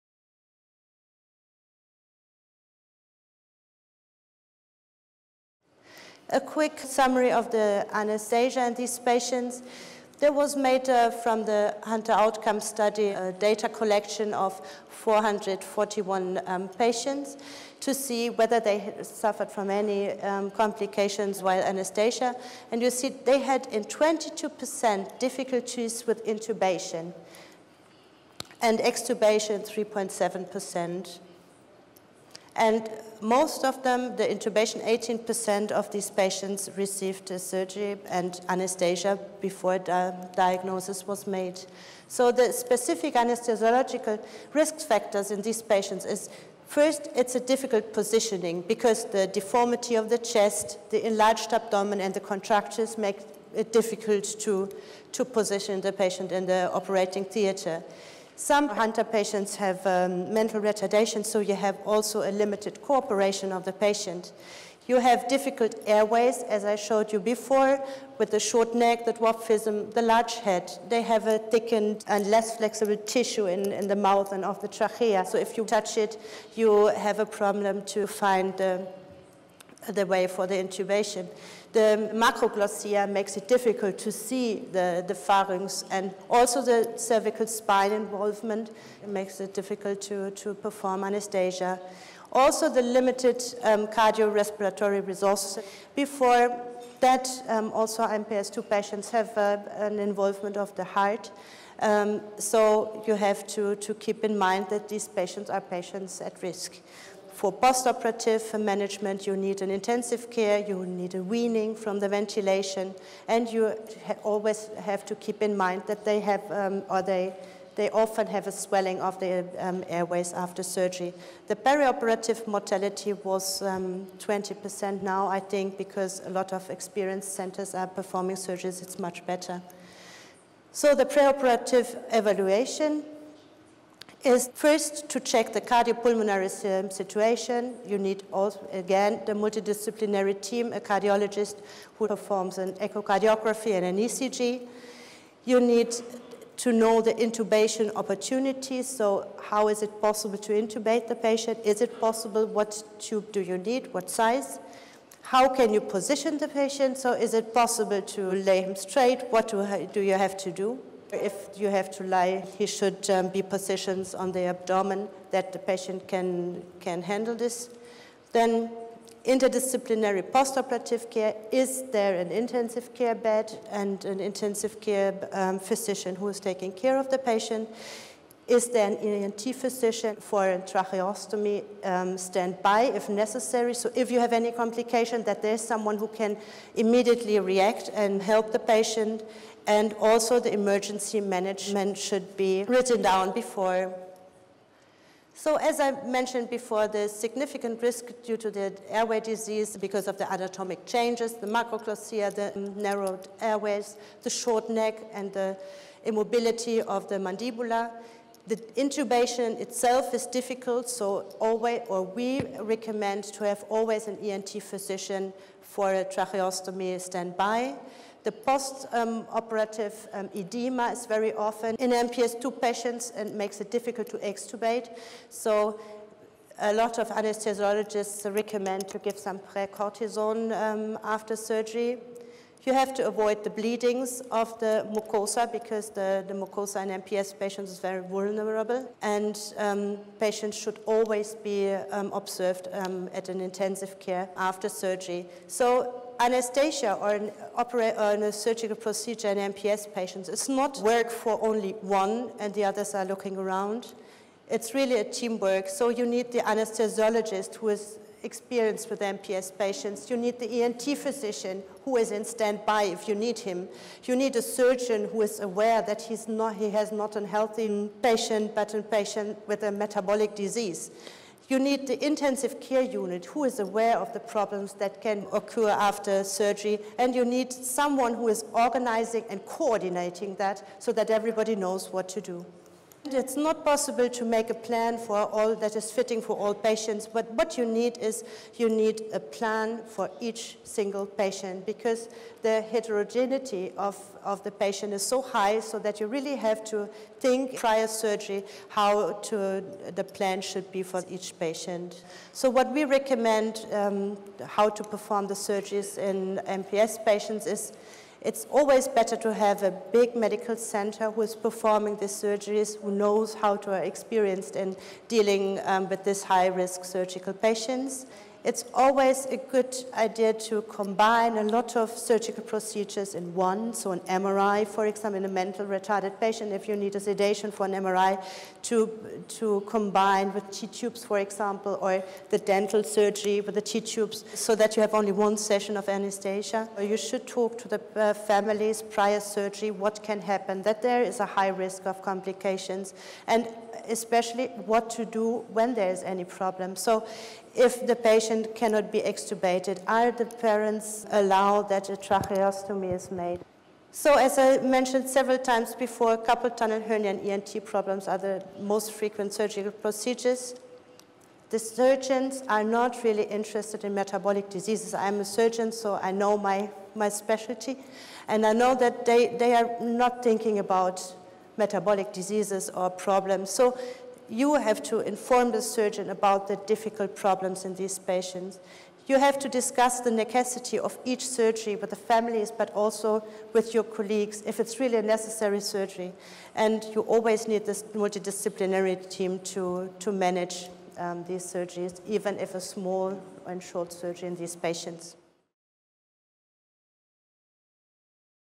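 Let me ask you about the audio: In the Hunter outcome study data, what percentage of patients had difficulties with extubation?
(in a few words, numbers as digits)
3.7%.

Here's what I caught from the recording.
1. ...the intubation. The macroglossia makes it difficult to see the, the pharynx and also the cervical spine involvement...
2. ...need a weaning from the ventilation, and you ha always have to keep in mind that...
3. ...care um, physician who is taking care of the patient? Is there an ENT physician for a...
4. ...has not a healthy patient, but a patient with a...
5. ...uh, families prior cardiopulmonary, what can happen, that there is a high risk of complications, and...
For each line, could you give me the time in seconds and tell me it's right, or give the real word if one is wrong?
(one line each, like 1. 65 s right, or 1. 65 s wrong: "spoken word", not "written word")
1. 80 s right
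2. 110 s right
3. 174 s right
4. 266 s right
5. 337 s wrong: "surgery", not "cardiopulmonary".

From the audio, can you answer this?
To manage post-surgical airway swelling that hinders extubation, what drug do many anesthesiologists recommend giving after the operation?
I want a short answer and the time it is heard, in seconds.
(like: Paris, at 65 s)
precortisone, at 229 s.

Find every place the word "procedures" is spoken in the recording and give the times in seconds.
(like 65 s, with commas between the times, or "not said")
248 s, 322 s, 359 s.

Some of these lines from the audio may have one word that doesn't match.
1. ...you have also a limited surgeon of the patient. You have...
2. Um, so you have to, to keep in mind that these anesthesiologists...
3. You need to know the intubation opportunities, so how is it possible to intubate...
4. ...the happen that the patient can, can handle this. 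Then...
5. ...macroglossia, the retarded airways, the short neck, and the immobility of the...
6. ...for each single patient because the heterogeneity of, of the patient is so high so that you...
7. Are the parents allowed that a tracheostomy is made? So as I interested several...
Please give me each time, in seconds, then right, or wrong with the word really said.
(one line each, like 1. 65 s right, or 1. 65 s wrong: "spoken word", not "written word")
1. 61 s wrong: "cooperation", not "surgeon"
2. 101 s wrong: "patients", not "anesthesiologists"
3. 145 s right
4. 164 s wrong: "abdomen", not "happen"
5. 201 s wrong: "narrowed", not "retarded"
6. 289 s right
7. 349 s wrong: "mentioned", not "interested".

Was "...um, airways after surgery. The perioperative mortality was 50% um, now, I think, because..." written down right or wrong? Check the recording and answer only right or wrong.
wrong.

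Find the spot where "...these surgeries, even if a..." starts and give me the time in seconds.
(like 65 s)
391 s.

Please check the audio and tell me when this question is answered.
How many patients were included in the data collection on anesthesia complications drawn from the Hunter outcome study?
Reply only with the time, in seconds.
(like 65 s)
14 s.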